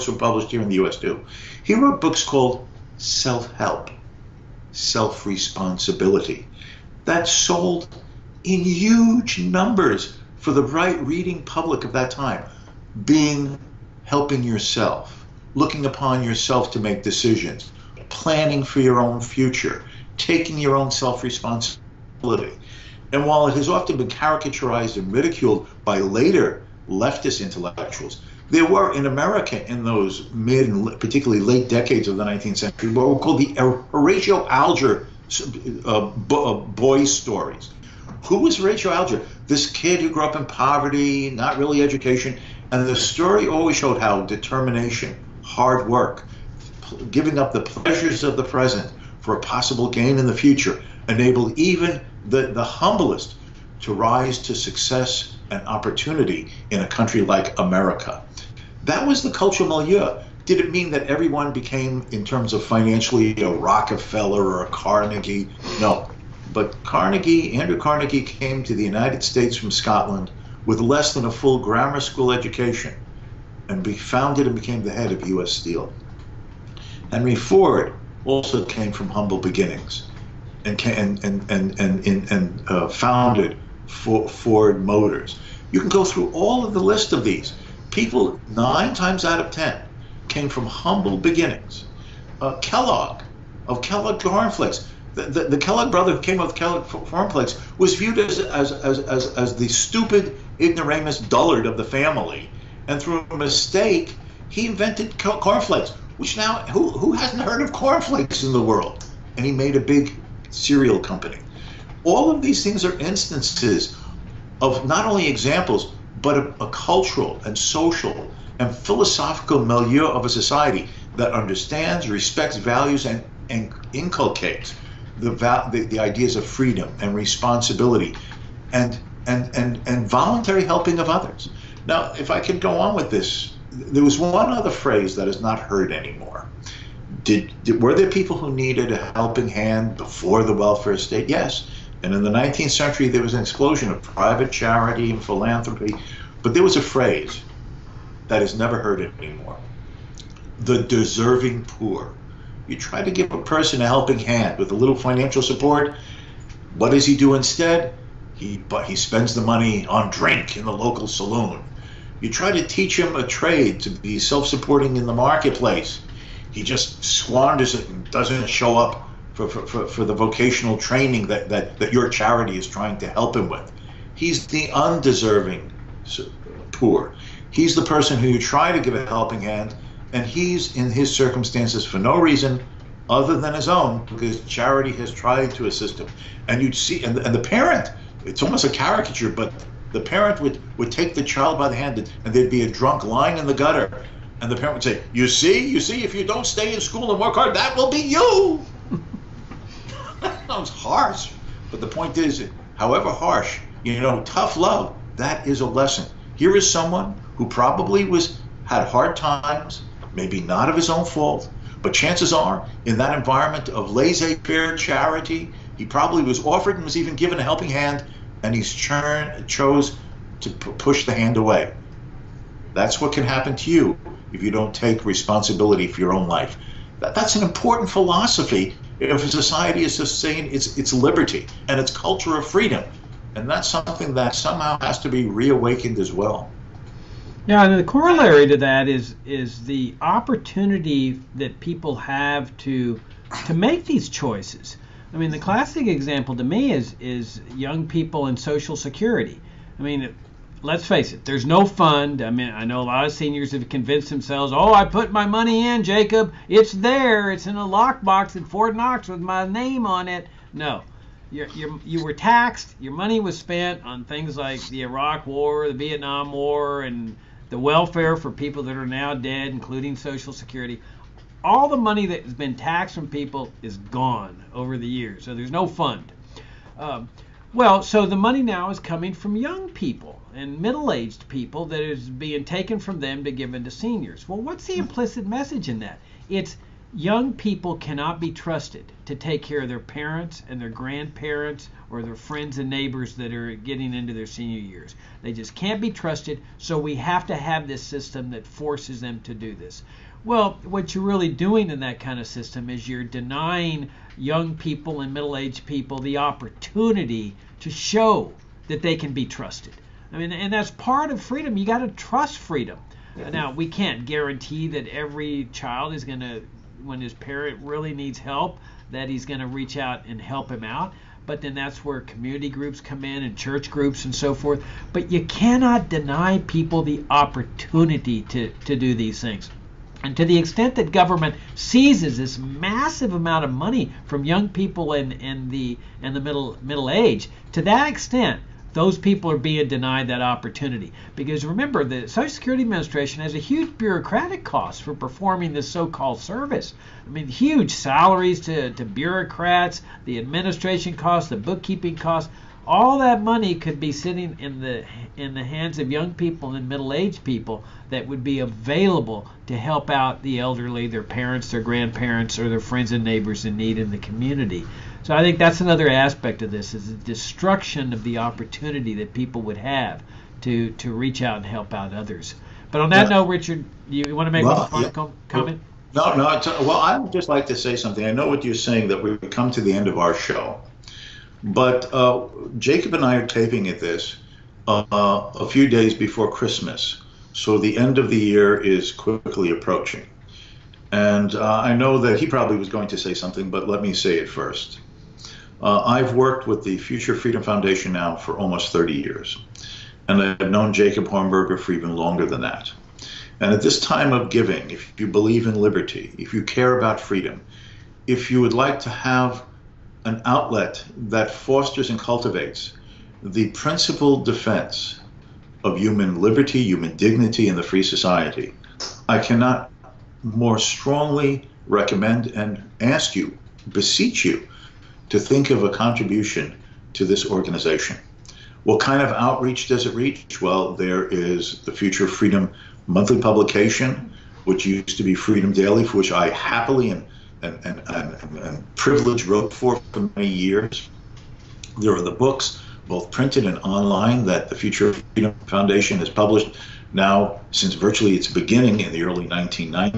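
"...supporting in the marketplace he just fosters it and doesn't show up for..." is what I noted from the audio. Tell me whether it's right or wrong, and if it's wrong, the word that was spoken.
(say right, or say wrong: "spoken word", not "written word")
wrong: "squanders", not "fosters".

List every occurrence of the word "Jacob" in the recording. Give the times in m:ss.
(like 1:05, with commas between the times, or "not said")
4:15, 6:22, 6:40.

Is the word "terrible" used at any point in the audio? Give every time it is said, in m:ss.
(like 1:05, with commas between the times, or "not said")
not said.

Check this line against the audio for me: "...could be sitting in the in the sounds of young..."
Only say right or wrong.
wrong.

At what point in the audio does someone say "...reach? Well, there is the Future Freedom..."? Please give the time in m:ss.
7:09.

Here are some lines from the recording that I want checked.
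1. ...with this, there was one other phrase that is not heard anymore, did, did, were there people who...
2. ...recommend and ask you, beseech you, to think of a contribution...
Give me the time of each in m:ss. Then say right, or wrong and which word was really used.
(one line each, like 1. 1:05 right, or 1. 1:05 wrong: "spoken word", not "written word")
1. 2:12 right
2. 7:01 right.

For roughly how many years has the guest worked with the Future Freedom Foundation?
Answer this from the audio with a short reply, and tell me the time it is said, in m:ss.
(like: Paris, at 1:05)
almost 30 years, at 6:38.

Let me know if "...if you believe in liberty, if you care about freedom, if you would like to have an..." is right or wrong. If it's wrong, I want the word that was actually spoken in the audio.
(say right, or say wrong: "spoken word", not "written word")
right.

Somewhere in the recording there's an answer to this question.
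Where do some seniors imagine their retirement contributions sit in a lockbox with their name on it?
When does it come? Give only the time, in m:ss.
4:18.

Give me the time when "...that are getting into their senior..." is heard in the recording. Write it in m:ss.
4:53.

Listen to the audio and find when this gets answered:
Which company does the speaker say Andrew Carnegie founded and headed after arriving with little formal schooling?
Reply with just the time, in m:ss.
1:15.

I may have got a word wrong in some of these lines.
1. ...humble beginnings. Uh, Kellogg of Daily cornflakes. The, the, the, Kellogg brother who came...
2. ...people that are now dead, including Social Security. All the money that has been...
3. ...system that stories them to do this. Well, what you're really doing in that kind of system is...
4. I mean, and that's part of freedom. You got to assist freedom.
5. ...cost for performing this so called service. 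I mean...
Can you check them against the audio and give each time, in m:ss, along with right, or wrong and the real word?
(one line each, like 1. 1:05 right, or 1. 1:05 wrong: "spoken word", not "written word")
1. 1:30 wrong: "Kellogg", not "Daily"
2. 4:28 right
3. 4:57 wrong: "forces", not "stories"
4. 5:10 wrong: "trust", not "assist"
5. 5:44 right.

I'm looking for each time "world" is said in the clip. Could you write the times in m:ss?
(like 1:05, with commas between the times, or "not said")
1:48.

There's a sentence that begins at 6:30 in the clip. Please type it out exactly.
And uh, I know that he probably was going to say something, but let me say it first.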